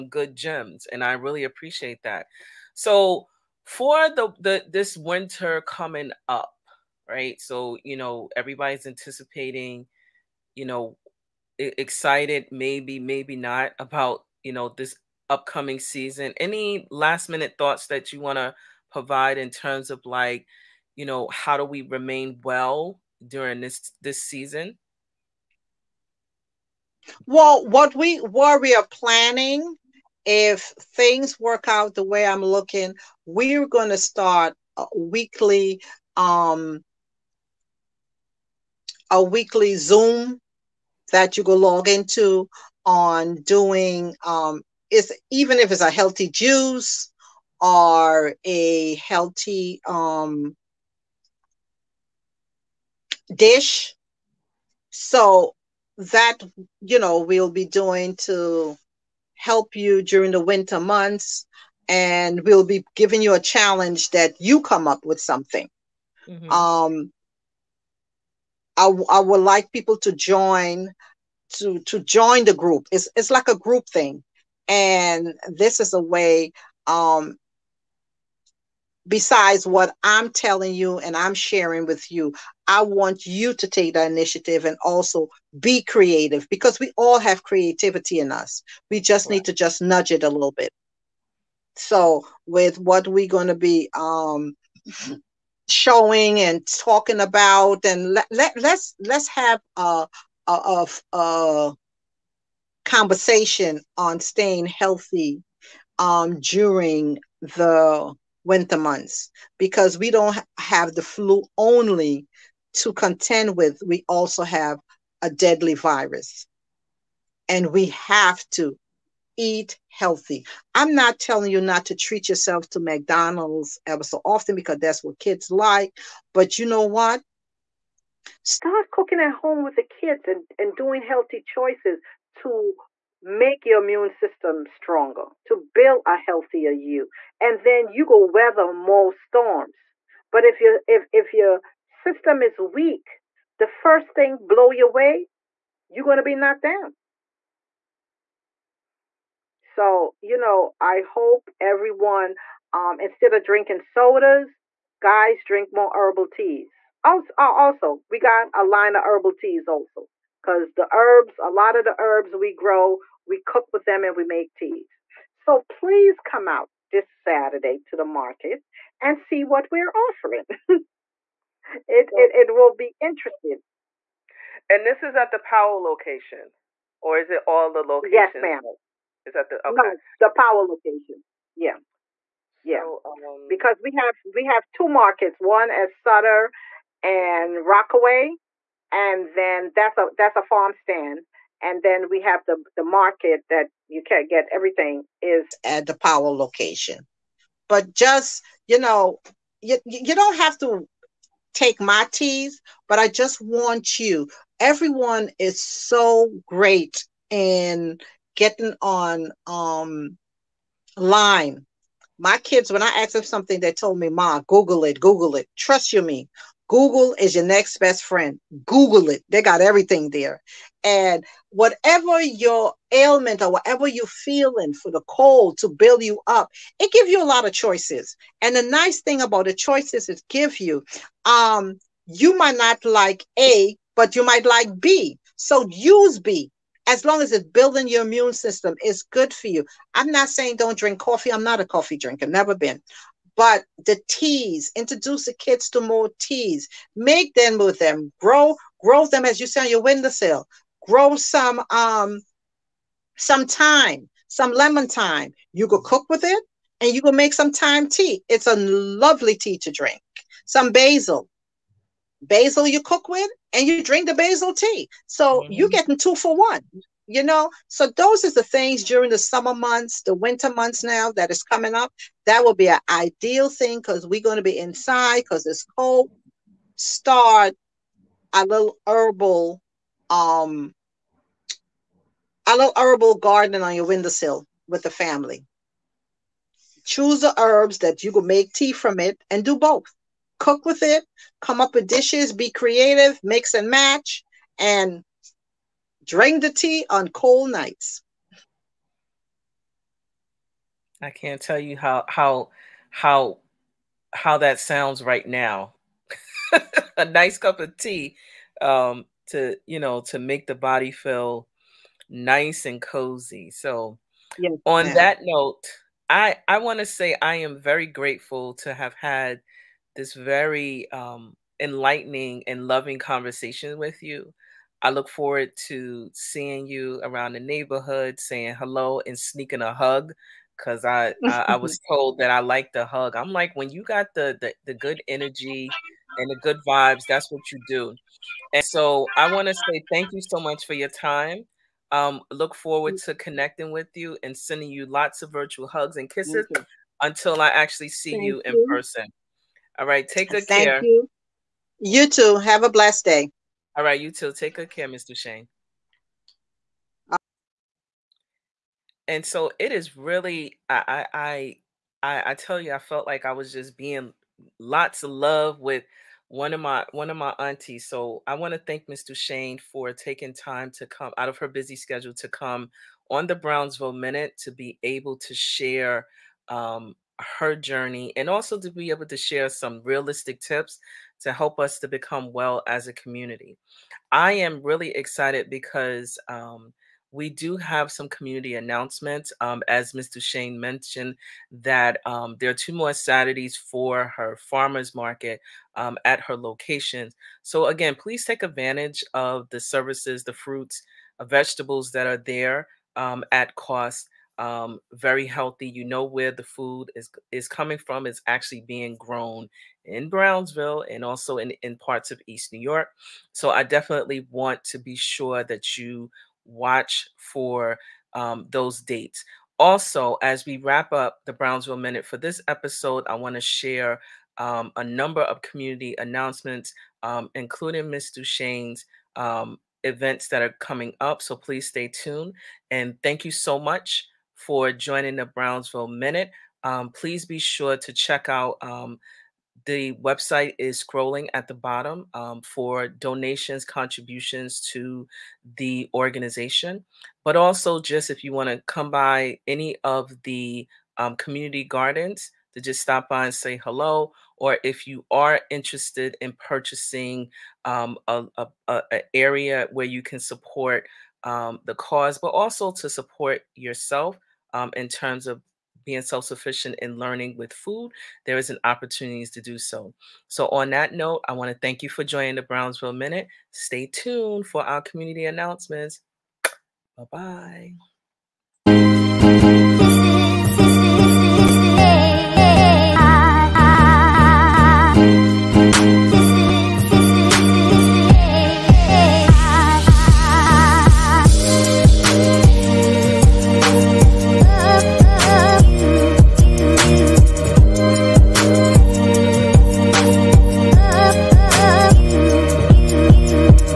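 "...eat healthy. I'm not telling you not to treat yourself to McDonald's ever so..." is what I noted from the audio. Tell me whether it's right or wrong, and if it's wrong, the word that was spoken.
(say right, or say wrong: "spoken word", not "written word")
right.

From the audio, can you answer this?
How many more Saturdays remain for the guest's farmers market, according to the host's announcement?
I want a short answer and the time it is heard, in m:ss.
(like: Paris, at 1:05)
2, at 6:32.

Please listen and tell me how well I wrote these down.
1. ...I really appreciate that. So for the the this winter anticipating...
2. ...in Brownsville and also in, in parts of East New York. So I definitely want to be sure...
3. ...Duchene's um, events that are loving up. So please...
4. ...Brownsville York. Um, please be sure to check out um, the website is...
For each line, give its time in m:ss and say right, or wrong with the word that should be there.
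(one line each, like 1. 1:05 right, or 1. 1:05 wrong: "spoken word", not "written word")
1. 0:01 wrong: "coming", not "anticipating"
2. 6:49 right
3. 7:08 wrong: "coming", not "loving"
4. 7:15 wrong: "Minute", not "York".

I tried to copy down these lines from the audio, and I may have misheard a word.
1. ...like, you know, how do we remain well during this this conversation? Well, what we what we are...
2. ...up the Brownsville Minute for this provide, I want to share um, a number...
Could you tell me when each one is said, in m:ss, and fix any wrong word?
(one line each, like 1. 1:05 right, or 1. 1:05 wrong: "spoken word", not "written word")
1. 0:20 wrong: "season", not "conversation"
2. 7:00 wrong: "episode", not "provide".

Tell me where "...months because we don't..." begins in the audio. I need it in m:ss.
1:48.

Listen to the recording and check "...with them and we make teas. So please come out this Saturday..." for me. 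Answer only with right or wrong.
right.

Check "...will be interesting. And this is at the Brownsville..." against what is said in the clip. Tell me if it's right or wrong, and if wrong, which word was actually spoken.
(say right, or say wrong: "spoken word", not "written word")
wrong: "Powell", not "Brownsville".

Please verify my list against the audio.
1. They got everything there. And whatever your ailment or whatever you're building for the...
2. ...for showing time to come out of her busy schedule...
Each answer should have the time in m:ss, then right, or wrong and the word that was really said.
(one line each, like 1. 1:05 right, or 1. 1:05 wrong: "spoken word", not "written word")
1. 3:39 wrong: "feeling", not "building"
2. 6:09 wrong: "taking", not "showing".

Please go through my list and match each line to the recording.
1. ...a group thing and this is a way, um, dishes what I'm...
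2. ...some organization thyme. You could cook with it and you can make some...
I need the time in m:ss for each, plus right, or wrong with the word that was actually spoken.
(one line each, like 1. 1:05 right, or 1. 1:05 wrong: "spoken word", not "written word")
1. 1:13 wrong: "besides", not "dishes"
2. 4:14 wrong: "lemon", not "organization".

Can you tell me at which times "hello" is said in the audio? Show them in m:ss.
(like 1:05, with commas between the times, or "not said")
5:28, 7:33.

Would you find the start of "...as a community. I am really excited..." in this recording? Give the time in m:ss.
6:22.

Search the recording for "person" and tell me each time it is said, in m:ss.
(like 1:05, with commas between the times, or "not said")
5:48.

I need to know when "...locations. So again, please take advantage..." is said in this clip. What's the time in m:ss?
6:36.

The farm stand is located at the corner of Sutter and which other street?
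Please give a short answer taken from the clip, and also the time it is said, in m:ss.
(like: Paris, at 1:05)
Rockaway, at 3:07.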